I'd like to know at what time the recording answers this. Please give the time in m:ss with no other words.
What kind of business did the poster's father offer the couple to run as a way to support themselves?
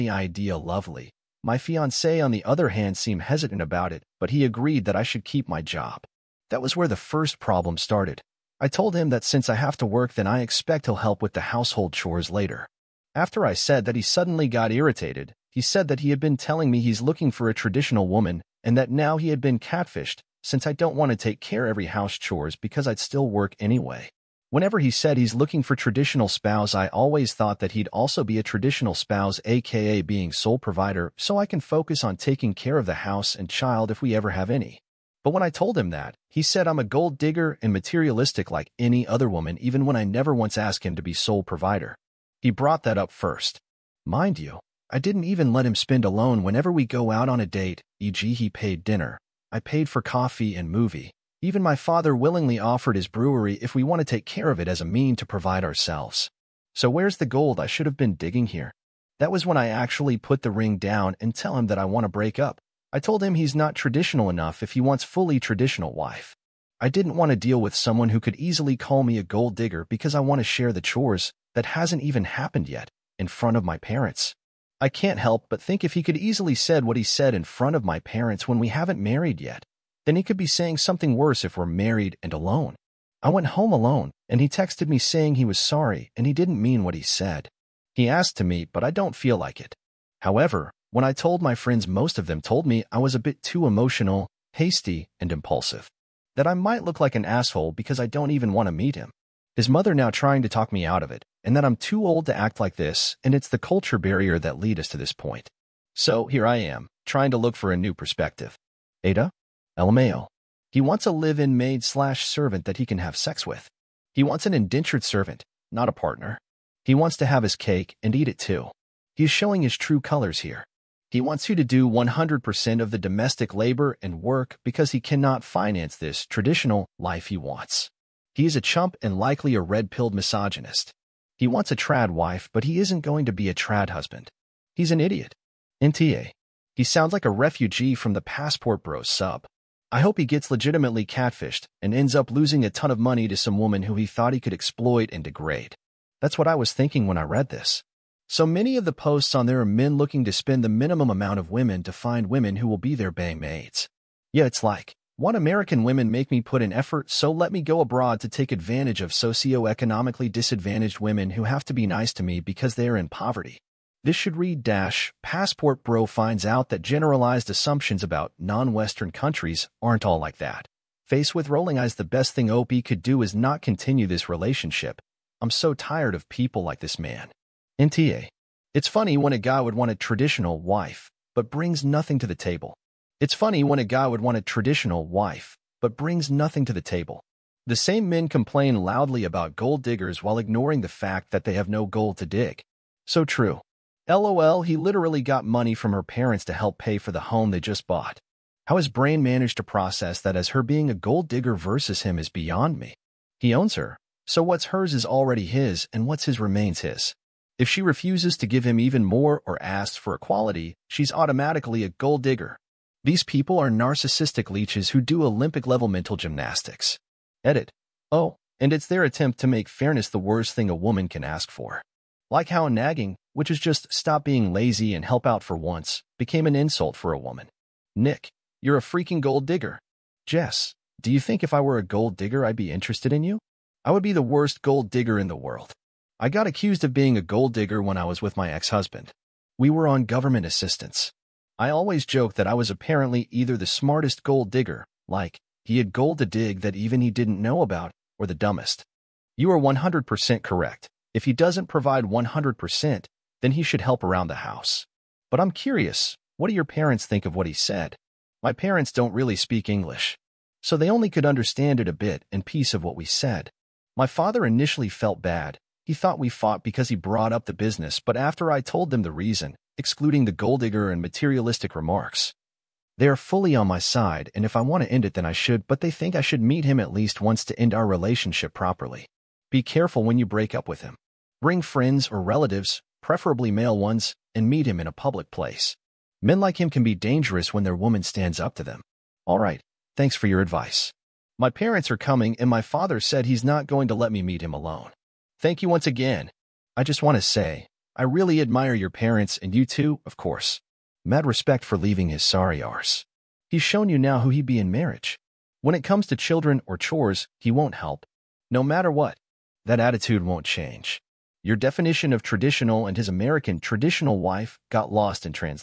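0:53.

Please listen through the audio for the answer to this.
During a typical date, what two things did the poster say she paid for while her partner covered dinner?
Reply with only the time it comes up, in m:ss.
0:50.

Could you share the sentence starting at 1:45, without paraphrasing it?
So here I am, trying to look for a new perspective.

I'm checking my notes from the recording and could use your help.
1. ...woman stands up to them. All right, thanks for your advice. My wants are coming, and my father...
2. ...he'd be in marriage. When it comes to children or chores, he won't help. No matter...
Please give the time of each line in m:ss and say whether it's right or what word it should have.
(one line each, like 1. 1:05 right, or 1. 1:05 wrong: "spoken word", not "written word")
1. 4:47 wrong: "parents", not "wants"
2. 5:04 right.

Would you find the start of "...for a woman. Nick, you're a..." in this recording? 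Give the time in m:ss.
3:46.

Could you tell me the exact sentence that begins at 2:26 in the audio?
That's what I was thinking when I read this.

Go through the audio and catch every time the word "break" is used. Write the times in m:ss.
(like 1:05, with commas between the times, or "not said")
1:02, 4:40.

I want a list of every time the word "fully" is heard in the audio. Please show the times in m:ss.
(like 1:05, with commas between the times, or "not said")
1:05, 4:33.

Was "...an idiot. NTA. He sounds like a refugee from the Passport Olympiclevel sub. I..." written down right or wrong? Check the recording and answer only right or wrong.
wrong.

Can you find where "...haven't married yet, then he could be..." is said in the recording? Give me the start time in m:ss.
1:18.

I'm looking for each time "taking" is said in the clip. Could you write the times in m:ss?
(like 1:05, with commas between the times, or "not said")
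0:32.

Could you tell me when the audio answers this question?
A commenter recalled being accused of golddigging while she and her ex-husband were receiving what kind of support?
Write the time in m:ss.
4:00.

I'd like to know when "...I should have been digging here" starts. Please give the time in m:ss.
0:57.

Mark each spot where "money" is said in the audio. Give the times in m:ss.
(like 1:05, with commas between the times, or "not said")
2:22, 3:15.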